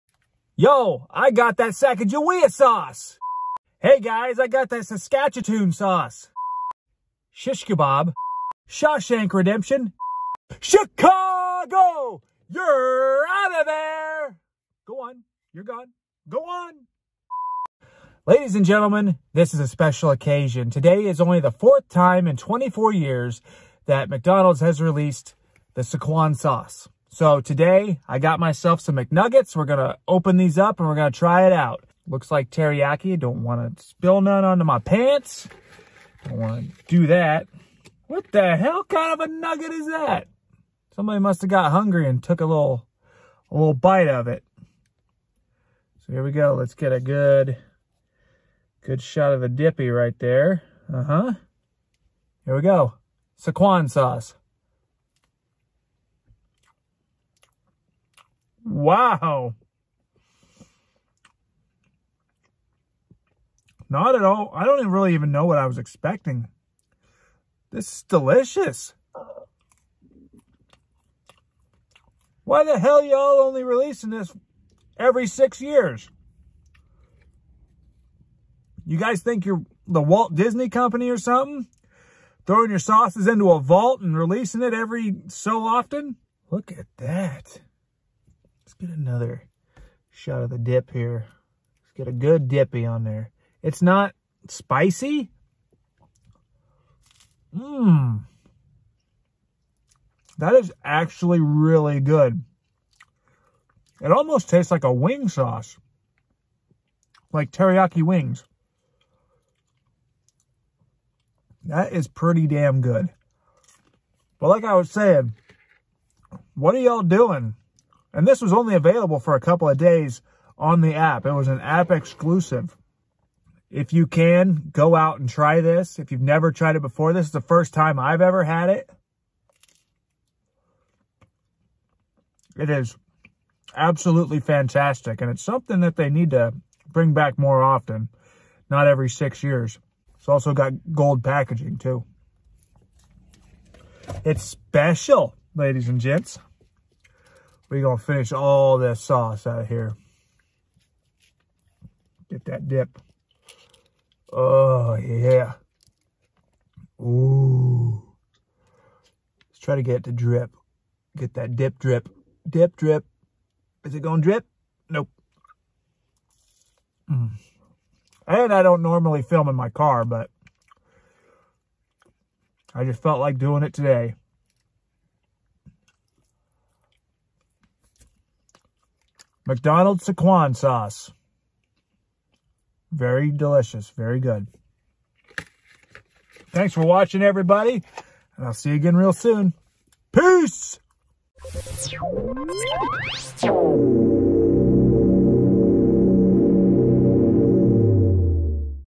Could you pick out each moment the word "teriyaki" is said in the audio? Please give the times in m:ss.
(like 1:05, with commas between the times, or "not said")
0:32, 1:47.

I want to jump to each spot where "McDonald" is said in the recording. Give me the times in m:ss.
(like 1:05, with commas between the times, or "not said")
0:24, 2:59.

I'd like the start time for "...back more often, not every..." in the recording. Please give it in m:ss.
2:17.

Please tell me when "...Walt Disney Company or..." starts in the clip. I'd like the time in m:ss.
1:20.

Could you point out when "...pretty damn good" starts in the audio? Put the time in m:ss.
1:52.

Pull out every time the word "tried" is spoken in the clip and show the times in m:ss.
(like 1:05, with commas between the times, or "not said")
2:06.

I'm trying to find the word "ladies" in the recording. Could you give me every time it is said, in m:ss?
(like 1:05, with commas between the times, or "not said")
0:18, 2:25.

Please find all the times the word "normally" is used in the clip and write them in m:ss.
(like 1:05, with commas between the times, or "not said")
2:48.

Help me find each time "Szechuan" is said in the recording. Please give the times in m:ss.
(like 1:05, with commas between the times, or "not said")
0:25, 0:53, 3:00.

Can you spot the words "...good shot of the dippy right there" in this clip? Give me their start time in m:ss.
0:48.